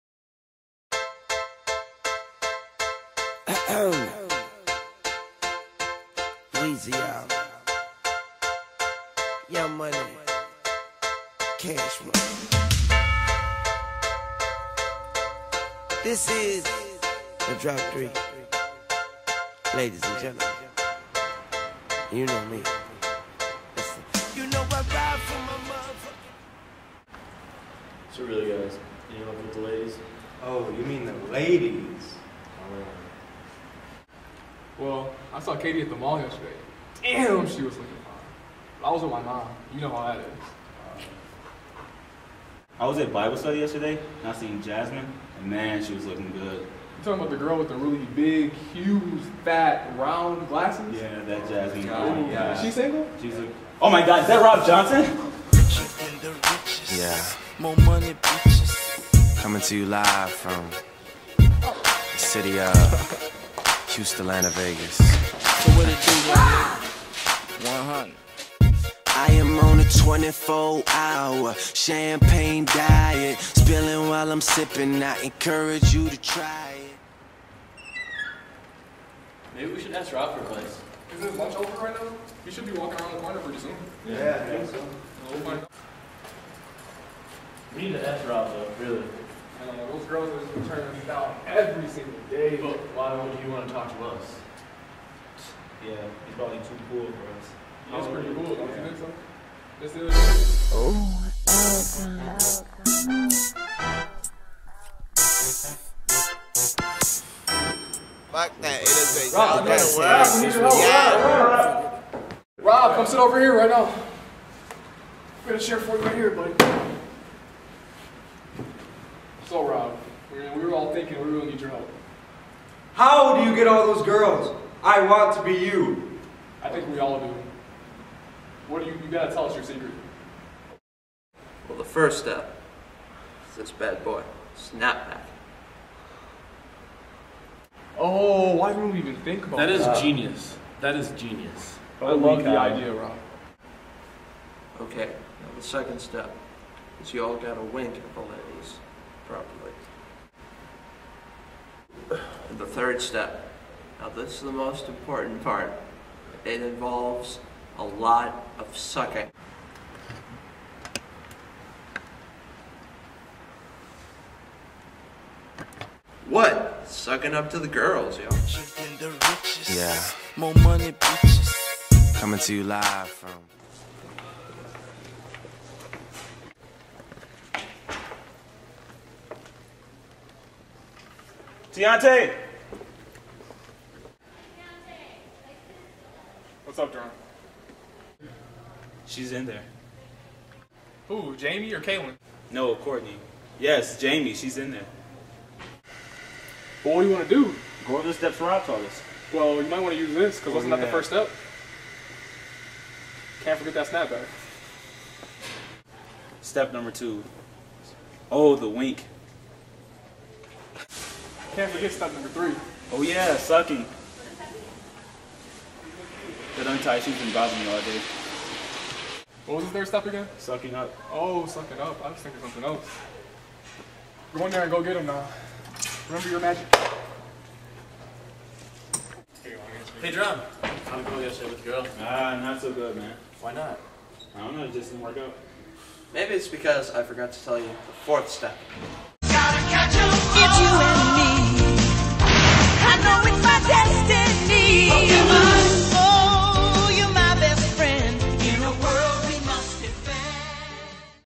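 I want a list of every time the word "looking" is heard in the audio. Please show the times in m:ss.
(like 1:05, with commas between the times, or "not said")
0:37, 0:46.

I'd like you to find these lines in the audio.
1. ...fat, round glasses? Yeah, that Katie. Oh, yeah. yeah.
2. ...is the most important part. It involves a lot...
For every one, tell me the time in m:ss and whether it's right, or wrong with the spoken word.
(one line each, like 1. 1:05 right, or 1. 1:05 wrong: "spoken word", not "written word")
1. 0:49 wrong: "Jasmine", not "Katie"
2. 2:34 right.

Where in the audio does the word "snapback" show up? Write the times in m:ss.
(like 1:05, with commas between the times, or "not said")
2:14, 3:23.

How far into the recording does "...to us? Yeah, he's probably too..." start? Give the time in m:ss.
1:33.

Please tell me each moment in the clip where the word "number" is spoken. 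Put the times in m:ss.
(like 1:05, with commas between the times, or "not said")
3:26, 3:32.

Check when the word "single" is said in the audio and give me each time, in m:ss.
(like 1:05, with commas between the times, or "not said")
0:52, 1:31.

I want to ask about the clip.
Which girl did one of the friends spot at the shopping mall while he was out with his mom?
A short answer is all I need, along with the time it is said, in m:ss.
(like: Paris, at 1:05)
Katie, at 0:35.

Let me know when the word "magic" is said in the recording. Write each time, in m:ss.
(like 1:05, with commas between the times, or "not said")
3:46.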